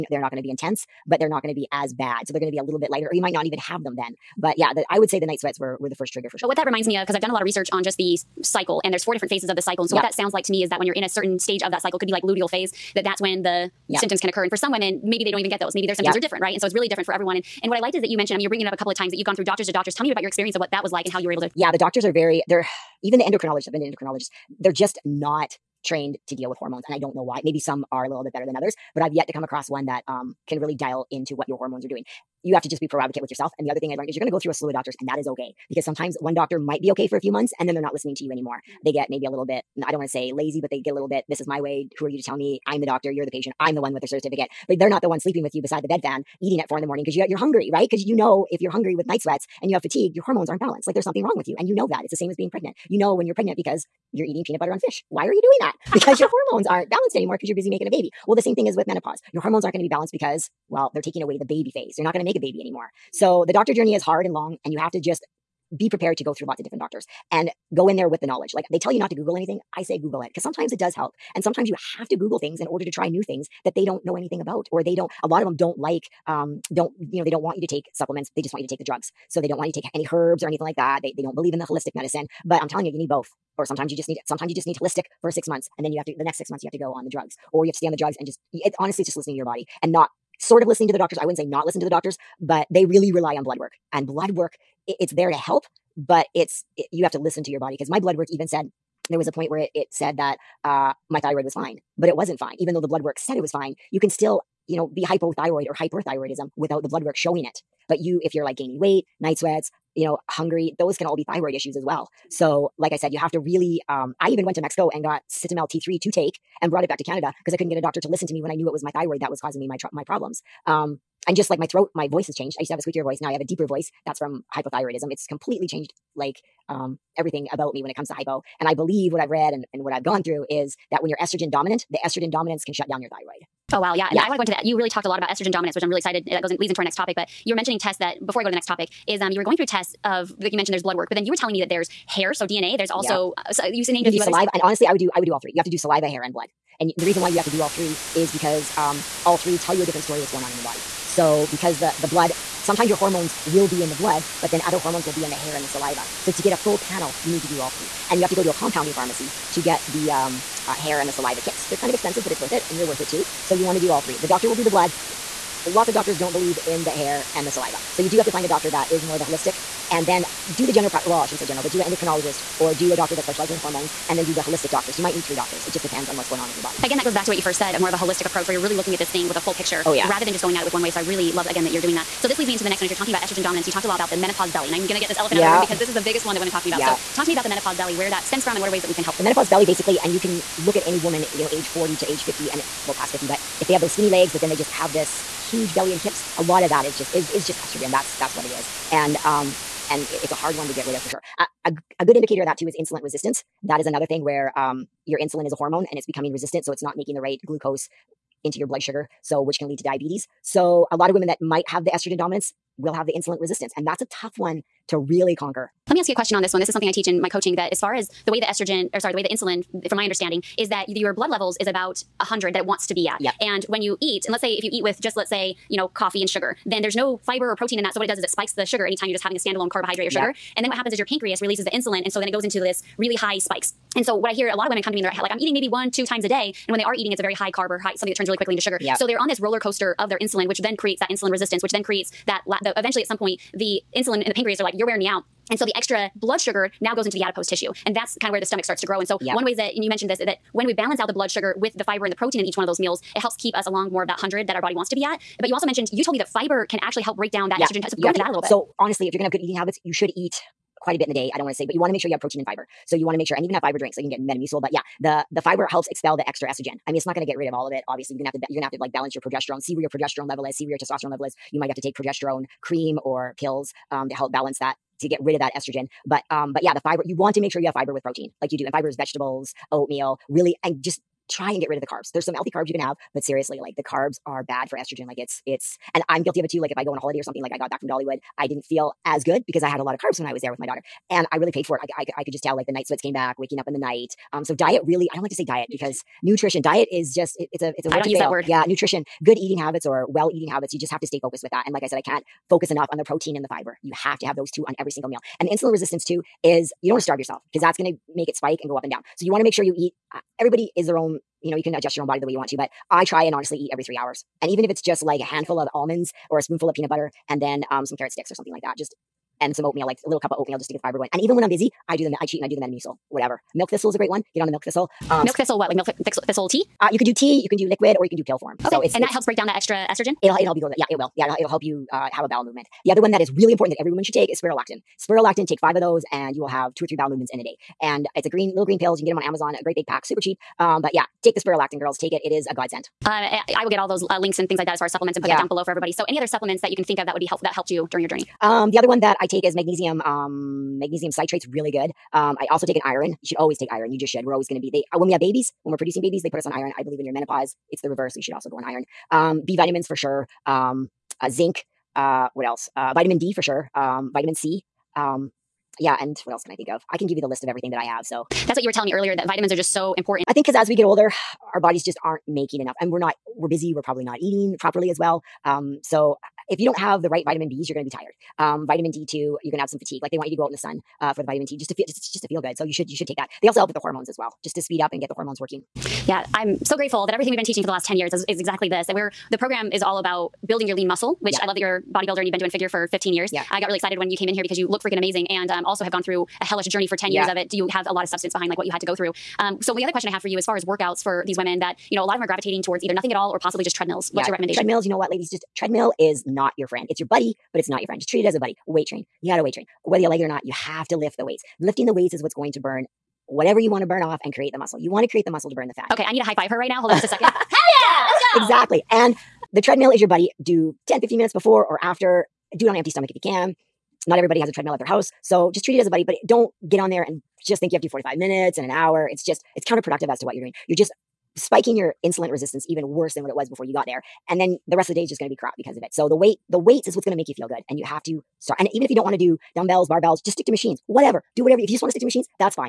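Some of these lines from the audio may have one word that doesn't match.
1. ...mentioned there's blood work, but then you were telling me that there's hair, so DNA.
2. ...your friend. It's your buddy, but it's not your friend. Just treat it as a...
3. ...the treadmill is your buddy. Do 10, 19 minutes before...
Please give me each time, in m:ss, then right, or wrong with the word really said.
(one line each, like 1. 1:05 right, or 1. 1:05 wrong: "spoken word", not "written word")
1. 2:20 right
2. 6:46 right
3. 6:59 wrong: "15", not "19".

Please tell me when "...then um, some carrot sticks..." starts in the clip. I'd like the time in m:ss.
5:17.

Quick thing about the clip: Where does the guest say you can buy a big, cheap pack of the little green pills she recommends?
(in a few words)
Amazon.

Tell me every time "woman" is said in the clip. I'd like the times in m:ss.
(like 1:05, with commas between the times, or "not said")
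3:10, 5:33.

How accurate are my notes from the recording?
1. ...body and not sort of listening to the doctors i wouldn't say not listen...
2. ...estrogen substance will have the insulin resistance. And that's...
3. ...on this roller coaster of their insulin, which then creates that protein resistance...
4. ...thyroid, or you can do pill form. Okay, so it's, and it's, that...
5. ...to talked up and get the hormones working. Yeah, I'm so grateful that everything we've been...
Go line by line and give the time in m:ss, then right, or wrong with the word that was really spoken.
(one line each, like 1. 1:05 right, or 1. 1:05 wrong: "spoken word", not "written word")
1. 1:29 right
2. 3:31 wrong: "dominance", not "substance"
3. 3:59 wrong: "insulin", not "protein"
4. 5:27 wrong: "liquid", not "thyroid"
5. 6:24 wrong: "speed", not "talked".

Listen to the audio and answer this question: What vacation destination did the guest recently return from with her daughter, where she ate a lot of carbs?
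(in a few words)
Dollywood.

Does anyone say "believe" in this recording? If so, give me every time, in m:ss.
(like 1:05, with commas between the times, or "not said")
1:21, 2:08, 2:46, 5:56.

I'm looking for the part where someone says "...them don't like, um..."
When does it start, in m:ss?
1:15.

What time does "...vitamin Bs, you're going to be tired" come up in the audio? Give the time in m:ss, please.
6:17.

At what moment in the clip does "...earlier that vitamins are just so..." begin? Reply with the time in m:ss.
6:08.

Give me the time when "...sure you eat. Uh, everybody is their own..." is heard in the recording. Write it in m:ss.
5:09.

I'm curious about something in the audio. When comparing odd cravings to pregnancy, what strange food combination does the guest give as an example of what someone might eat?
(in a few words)
peanut butter on fish.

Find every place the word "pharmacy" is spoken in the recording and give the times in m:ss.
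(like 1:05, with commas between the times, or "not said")
2:38.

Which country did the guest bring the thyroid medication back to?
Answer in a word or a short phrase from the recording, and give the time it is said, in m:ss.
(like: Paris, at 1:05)
Canada, at 1:57.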